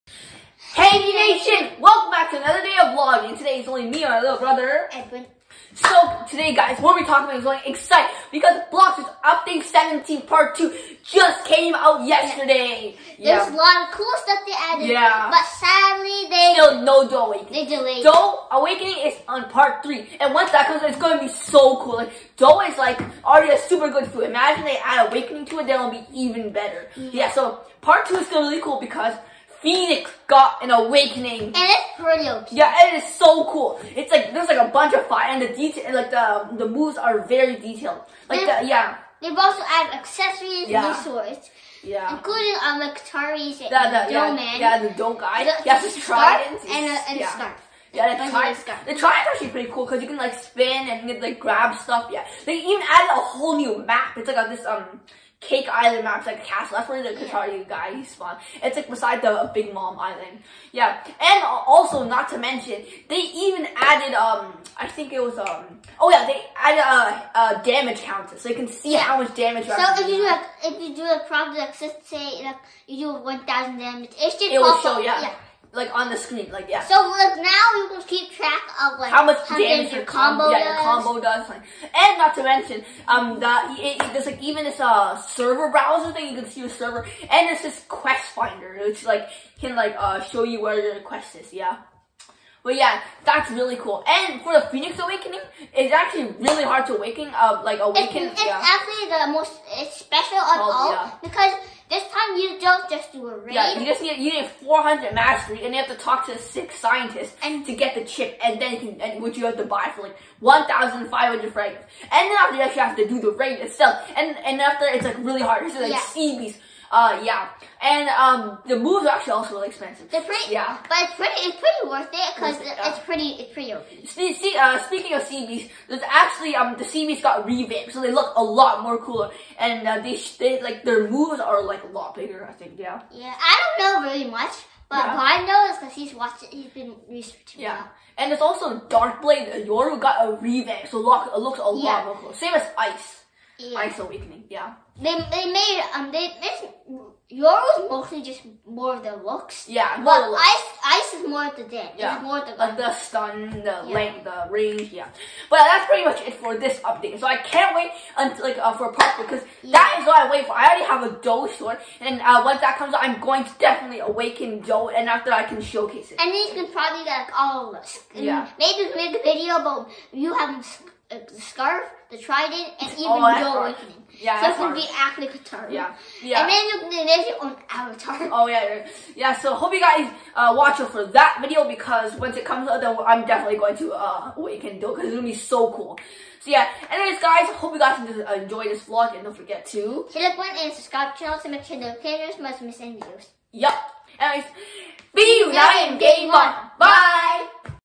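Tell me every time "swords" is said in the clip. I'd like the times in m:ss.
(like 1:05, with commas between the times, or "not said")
0:41, 2:41.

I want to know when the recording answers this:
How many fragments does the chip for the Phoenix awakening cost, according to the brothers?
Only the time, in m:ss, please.
1:50.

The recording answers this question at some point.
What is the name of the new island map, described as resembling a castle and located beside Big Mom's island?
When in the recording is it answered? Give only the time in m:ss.
0:55.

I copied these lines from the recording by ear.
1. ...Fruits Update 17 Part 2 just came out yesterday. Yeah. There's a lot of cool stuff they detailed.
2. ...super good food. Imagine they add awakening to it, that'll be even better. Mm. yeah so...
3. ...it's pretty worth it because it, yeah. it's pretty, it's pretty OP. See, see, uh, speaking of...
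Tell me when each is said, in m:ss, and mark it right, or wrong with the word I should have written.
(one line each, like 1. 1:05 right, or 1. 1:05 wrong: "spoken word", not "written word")
1. 0:08 wrong: "added", not "detailed"
2. 0:23 right
3. 2:01 right.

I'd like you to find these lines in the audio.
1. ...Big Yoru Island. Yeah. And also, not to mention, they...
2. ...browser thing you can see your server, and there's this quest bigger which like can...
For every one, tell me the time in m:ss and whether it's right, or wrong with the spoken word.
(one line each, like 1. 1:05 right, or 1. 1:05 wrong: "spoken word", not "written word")
1. 0:59 wrong: "Mom", not "Yoru"
2. 1:25 wrong: "finder", not "bigger".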